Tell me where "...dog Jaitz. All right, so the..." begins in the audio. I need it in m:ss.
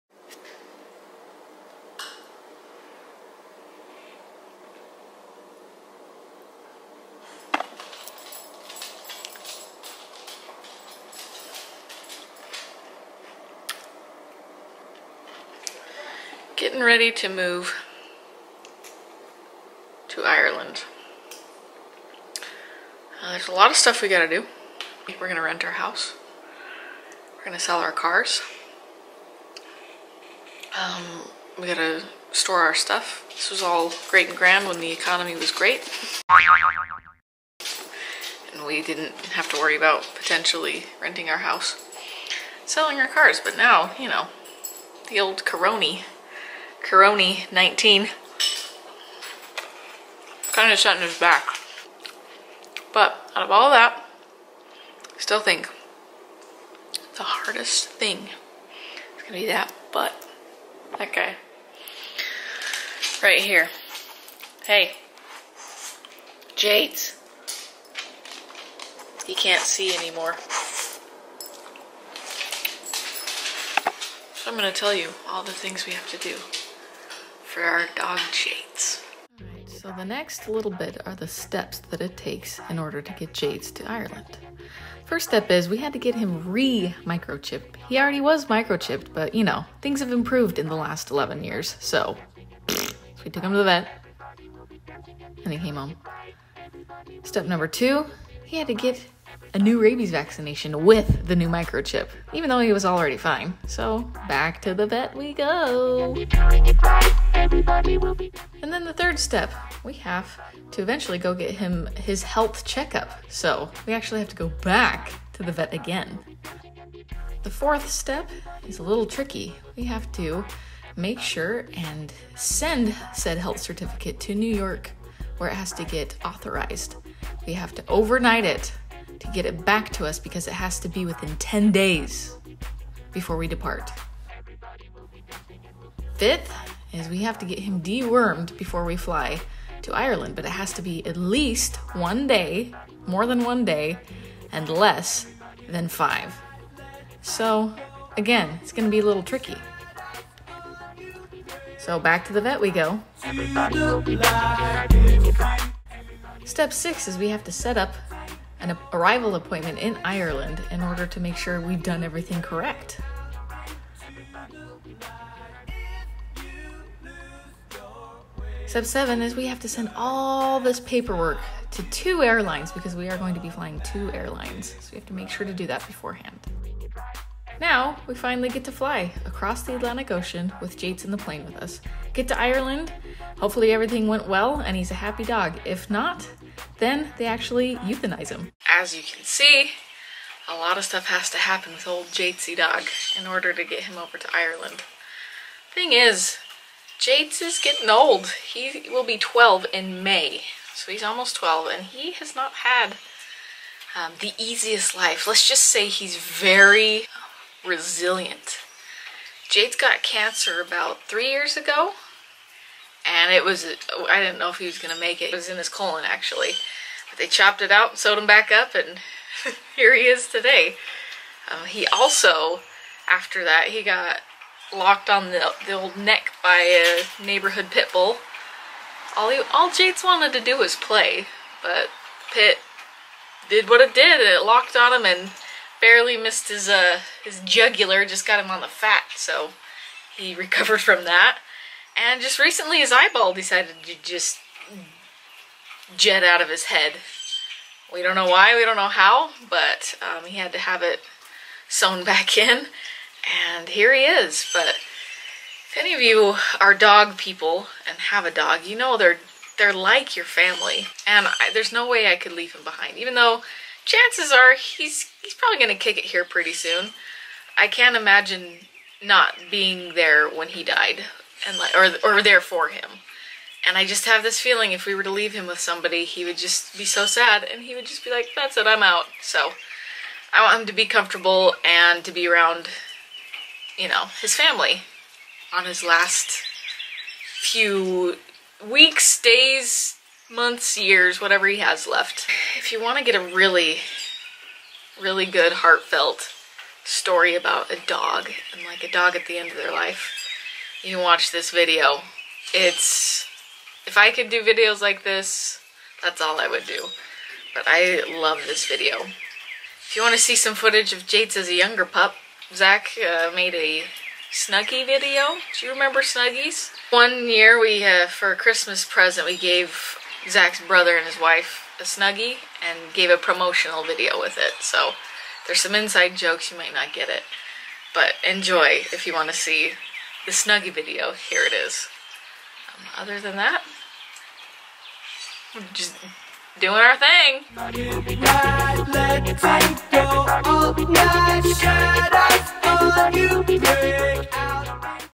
1:17.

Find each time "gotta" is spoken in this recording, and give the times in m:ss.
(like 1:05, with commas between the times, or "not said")
0:24, 0:31.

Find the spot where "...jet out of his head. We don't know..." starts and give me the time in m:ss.
4:05.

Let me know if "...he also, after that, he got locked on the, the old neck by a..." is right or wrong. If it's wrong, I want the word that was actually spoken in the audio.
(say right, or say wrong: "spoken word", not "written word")
right.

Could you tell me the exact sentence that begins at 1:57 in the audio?
The fourth step is a little tricky.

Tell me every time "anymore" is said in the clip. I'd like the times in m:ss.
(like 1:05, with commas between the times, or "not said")
1:09.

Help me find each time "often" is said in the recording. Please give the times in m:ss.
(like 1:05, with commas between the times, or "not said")
not said.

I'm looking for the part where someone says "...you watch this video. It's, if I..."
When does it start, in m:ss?
5:00.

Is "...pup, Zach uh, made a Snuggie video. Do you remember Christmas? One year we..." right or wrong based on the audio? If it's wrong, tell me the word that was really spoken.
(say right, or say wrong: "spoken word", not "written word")
wrong: "Snuggies", not "Christmas".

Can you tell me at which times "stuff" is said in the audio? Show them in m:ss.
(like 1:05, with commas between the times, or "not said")
0:23, 0:32, 3:10.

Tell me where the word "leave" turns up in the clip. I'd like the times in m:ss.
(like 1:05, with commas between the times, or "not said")
4:22, 4:35.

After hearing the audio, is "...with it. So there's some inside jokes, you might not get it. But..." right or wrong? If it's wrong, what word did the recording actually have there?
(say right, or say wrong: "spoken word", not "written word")
right.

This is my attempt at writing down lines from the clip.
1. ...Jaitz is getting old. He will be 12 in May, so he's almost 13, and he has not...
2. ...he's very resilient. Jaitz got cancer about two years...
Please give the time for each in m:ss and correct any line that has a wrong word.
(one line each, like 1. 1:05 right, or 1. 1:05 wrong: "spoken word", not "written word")
1. 3:16 wrong: "12", not "13"
2. 3:25 wrong: "three", not "two".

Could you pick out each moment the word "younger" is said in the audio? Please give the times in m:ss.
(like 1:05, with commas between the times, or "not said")
5:11.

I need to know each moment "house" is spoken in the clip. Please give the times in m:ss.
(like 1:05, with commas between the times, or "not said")
0:25, 0:41.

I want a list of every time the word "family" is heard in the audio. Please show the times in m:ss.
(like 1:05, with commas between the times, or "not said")
4:20, 4:44.